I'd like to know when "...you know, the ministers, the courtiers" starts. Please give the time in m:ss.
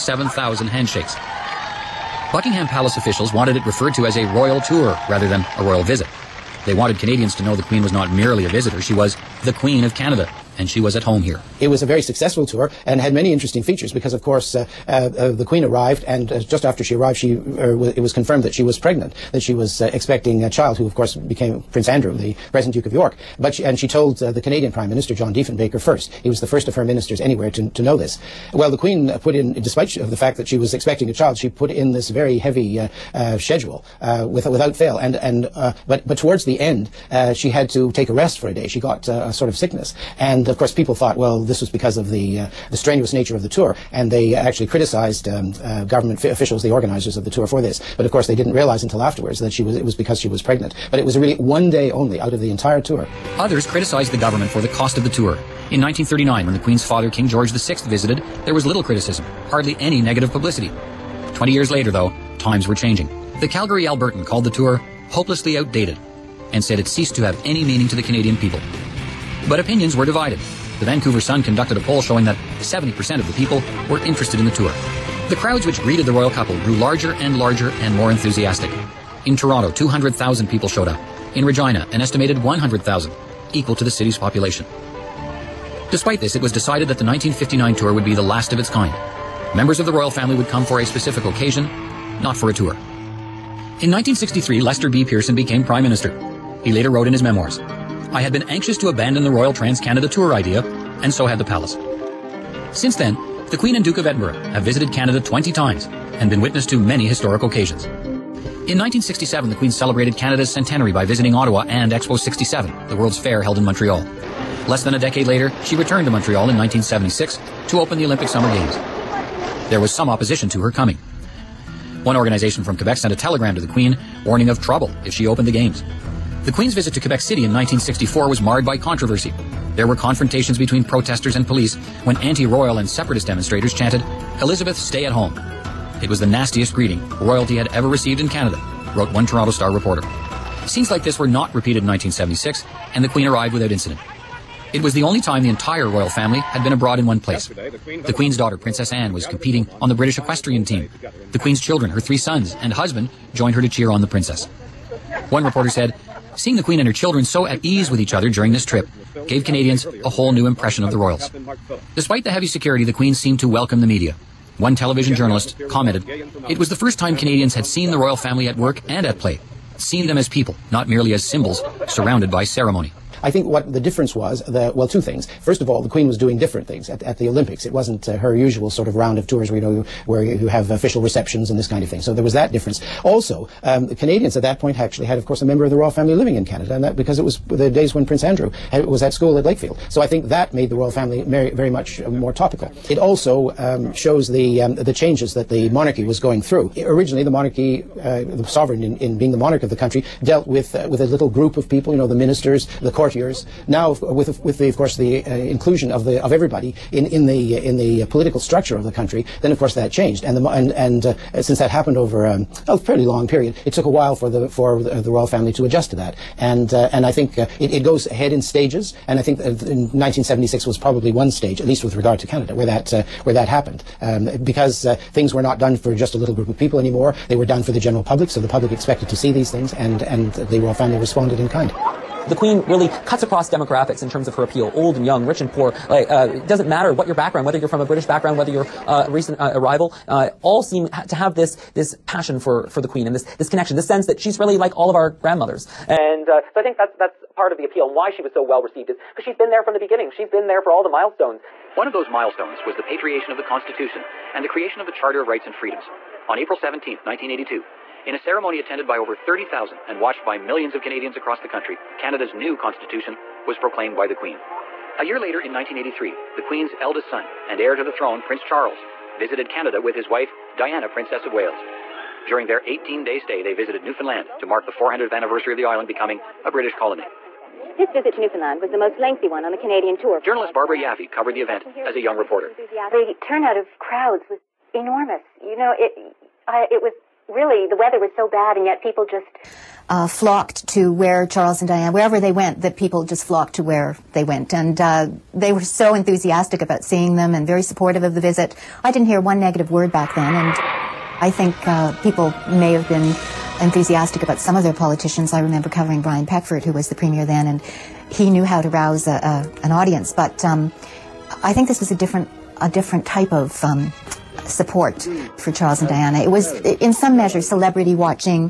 3:21.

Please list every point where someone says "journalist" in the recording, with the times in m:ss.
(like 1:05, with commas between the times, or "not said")
2:45, 4:40.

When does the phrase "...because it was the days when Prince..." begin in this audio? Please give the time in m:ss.
3:06.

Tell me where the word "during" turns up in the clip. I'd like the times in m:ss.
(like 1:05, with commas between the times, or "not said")
2:38, 4:32.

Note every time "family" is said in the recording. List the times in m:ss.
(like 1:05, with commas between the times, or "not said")
1:30, 2:26, 2:48, 3:05, 3:10, 3:35, 3:50.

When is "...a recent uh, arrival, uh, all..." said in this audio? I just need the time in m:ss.
3:59.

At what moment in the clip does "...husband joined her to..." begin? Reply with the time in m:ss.
2:32.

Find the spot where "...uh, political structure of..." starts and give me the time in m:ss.
3:28.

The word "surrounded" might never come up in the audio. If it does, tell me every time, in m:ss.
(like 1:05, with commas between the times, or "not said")
2:51.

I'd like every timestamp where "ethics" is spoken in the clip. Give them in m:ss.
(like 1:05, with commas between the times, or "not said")
not said.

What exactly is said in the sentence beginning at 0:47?
But of course, they didn't realize until afterwards that she was, it was because she was pregnant.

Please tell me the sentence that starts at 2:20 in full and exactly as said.
Scenes like this were not repeated in 1976, and the Queen arrived without incident.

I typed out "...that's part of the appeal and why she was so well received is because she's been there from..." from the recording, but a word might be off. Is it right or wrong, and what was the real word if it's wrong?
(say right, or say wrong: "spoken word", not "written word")
right.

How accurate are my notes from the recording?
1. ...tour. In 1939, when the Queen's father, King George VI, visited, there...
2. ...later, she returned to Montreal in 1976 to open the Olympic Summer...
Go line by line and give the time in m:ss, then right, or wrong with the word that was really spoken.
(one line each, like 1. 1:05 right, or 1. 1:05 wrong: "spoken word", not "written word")
1. 0:55 right
2. 1:55 right.